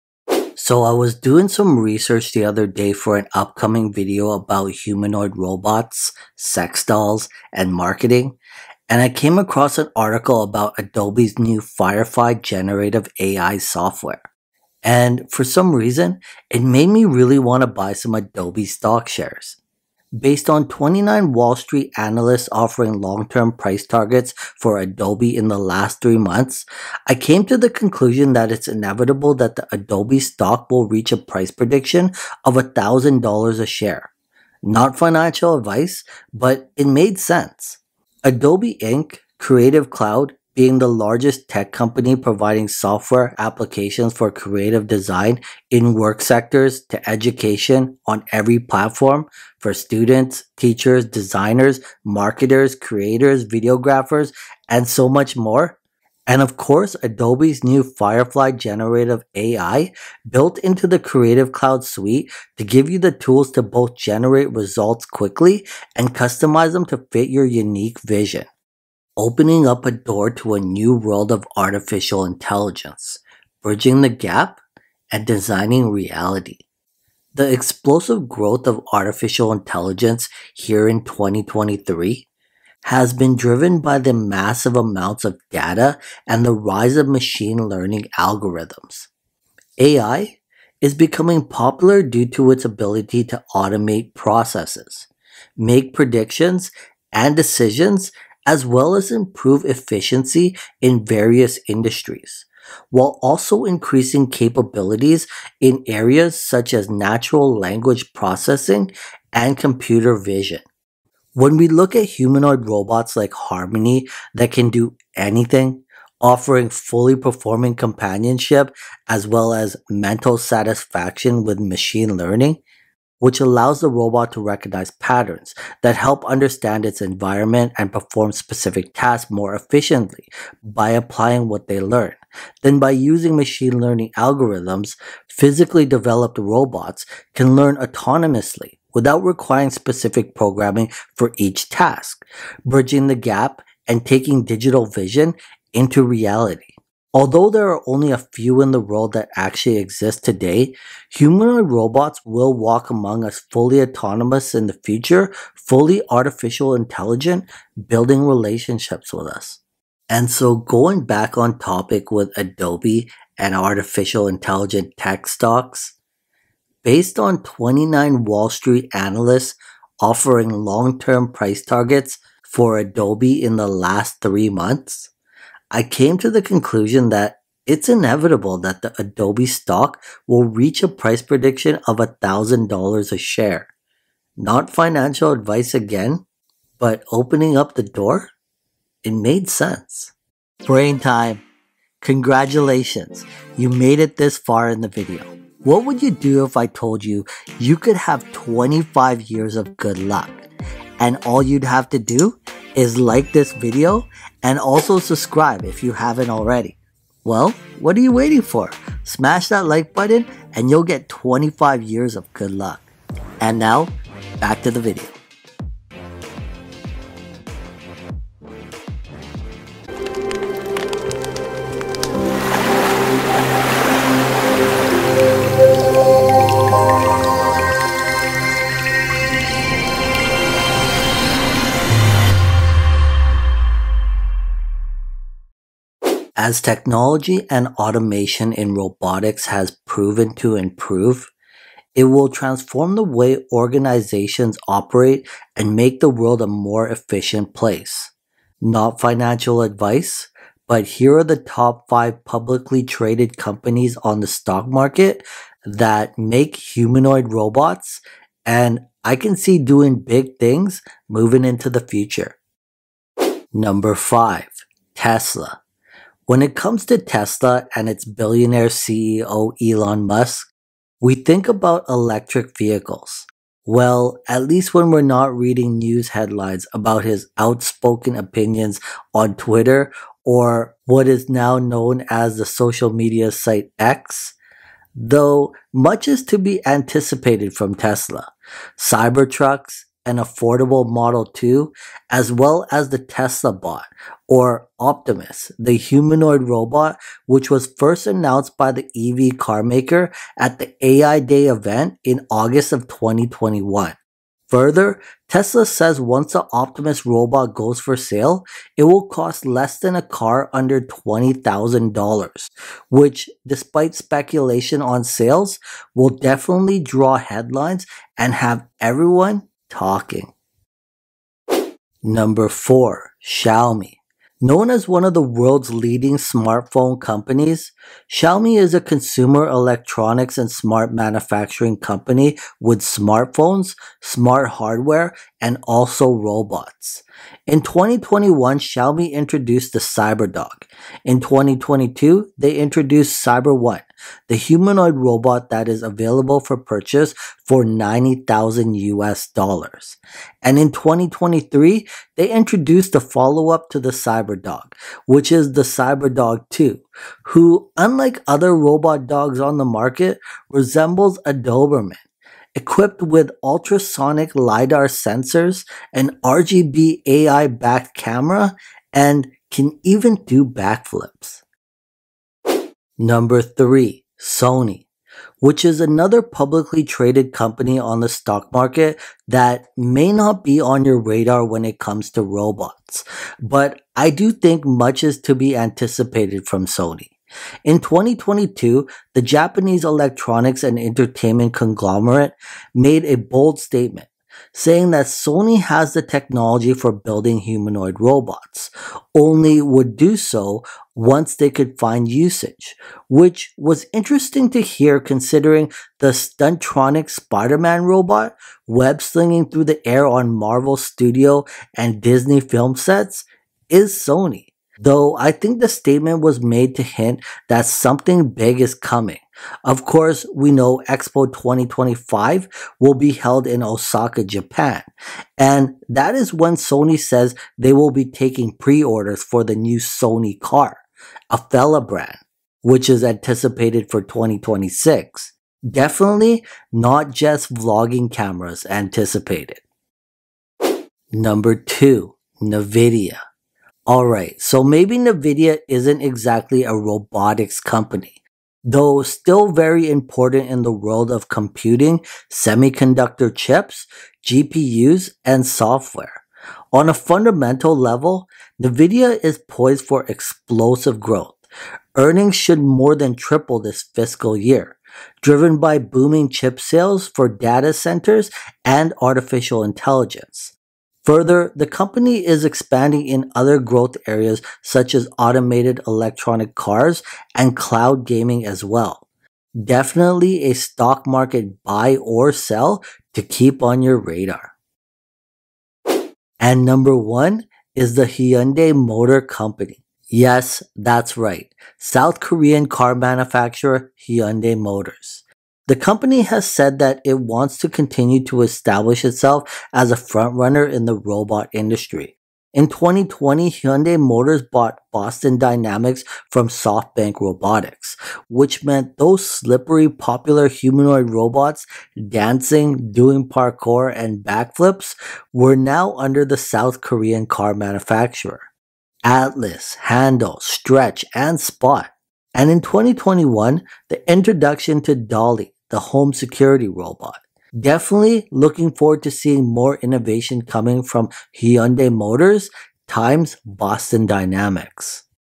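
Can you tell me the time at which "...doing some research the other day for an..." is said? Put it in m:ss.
0:01.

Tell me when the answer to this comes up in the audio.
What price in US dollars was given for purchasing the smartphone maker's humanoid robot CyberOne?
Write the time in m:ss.
5:47.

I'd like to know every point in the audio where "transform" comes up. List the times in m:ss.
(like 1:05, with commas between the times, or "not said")
4:02.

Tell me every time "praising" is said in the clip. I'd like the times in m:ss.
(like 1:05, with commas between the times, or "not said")
not said.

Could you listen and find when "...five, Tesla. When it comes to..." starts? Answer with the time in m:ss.
4:23.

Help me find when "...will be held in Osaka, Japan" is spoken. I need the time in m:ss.
7:02.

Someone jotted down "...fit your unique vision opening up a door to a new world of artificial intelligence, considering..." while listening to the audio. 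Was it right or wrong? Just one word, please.
wrong.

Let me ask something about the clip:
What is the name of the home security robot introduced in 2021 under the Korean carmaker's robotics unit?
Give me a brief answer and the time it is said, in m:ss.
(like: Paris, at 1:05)
Dolly, at 8:44.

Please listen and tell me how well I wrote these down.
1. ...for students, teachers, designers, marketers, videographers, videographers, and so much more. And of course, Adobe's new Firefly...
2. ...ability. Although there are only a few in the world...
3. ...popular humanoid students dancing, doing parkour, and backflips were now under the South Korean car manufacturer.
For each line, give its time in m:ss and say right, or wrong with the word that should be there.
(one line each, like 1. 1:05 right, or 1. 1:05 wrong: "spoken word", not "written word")
1. 0:49 wrong: "creators", not "videographers"
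2. 2:26 wrong: "reality", not "ability"
3. 8:29 wrong: "robots", not "students".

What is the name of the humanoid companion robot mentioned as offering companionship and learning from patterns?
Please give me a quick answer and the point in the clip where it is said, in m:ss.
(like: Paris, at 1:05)
Harmony, at 1:53.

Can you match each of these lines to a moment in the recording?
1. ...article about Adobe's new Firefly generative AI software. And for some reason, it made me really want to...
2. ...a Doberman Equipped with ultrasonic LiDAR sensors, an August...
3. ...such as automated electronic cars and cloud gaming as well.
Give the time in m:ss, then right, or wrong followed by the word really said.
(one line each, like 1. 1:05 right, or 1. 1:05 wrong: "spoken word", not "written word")
1. 0:09 right
2. 6:01 wrong: "RGB", not "August"
3. 7:54 right.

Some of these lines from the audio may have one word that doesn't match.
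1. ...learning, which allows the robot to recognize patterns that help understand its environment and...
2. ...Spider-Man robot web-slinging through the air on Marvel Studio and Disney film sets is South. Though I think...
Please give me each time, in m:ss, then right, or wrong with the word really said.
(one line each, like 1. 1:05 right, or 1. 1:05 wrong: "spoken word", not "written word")
1. 2:02 right
2. 6:47 wrong: "Sony", not "South".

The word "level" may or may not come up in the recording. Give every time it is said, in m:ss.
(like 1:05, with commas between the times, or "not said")
7:37.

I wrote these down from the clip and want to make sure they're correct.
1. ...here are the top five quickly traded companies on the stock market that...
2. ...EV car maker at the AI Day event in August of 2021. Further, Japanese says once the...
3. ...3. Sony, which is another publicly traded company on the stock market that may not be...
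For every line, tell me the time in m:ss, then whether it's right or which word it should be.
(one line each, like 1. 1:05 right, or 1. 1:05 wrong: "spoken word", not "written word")
1. 4:10 wrong: "publicly", not "quickly"
2. 4:58 wrong: "Tesla", not "Japanese"
3. 6:13 right.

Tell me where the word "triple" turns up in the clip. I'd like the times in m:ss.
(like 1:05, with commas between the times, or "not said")
7:43.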